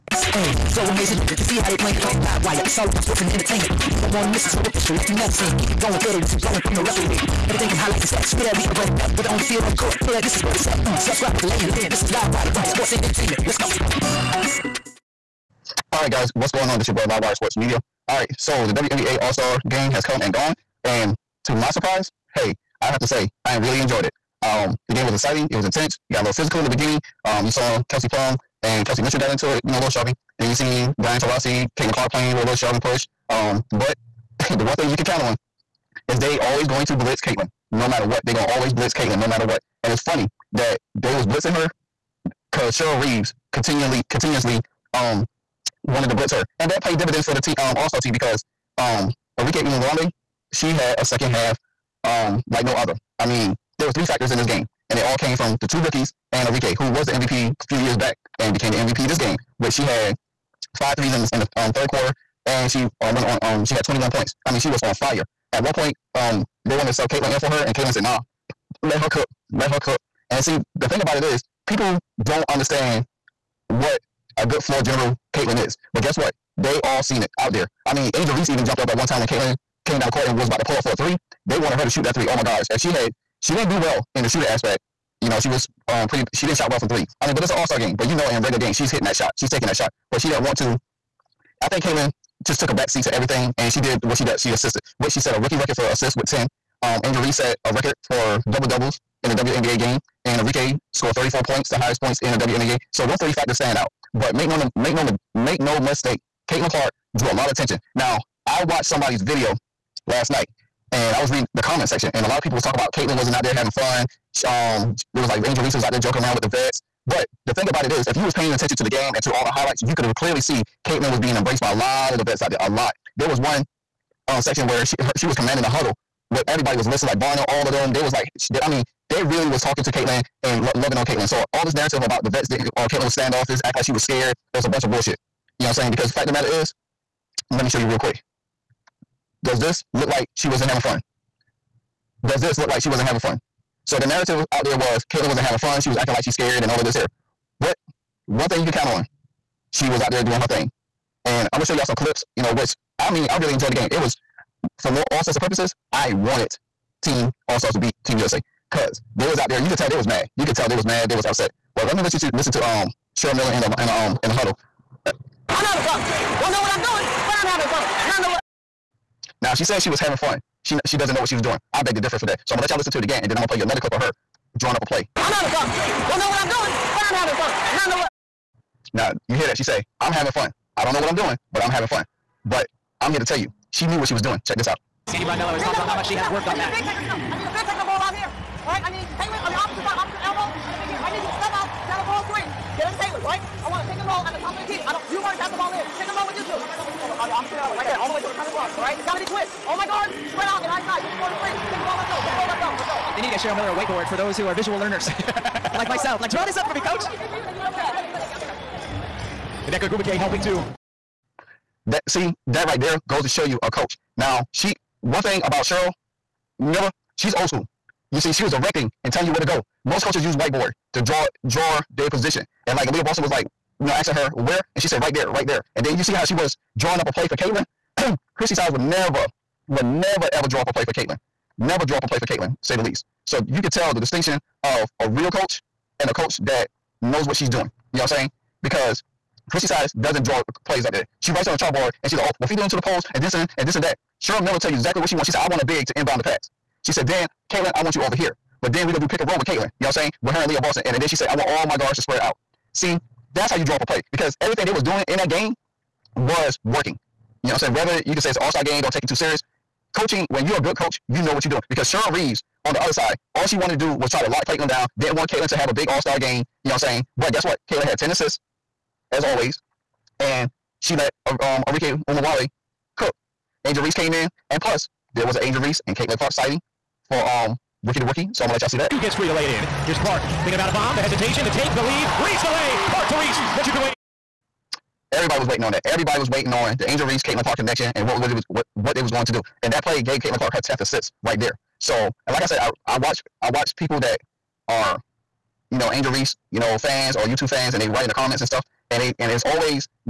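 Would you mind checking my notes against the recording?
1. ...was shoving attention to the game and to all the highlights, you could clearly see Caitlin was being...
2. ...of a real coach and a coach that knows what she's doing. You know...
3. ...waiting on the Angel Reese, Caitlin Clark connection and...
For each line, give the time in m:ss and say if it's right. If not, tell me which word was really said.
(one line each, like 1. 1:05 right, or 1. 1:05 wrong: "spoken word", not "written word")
1. 1:58 wrong: "paying", not "shoving"
2. 3:54 right
3. 4:46 right.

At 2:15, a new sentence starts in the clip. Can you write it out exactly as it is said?
Because fact of the matter is, let me show you real quick.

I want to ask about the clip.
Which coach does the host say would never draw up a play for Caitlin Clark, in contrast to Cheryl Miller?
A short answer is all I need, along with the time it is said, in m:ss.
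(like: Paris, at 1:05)
Christie Sides, at 3:48.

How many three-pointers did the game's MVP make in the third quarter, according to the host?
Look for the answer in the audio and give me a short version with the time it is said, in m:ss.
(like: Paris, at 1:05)
5, at 1:00.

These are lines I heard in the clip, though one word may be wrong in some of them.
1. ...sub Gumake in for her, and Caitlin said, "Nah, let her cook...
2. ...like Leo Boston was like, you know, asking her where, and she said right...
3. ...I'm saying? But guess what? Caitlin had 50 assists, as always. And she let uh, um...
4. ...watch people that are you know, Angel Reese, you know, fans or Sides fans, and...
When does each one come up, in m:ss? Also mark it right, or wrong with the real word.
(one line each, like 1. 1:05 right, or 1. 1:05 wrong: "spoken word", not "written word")
1. 1:06 wrong: "Caitlin", not "Gumake"
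2. 3:42 right
3. 4:26 wrong: "10", not "50"
4. 4:53 wrong: "YouTube", not "Sides".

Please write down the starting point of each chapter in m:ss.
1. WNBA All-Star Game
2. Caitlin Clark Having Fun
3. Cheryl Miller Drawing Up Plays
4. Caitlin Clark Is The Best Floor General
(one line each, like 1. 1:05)
1. 0:17
2. 2:24
3. 3:23
4. 4:52.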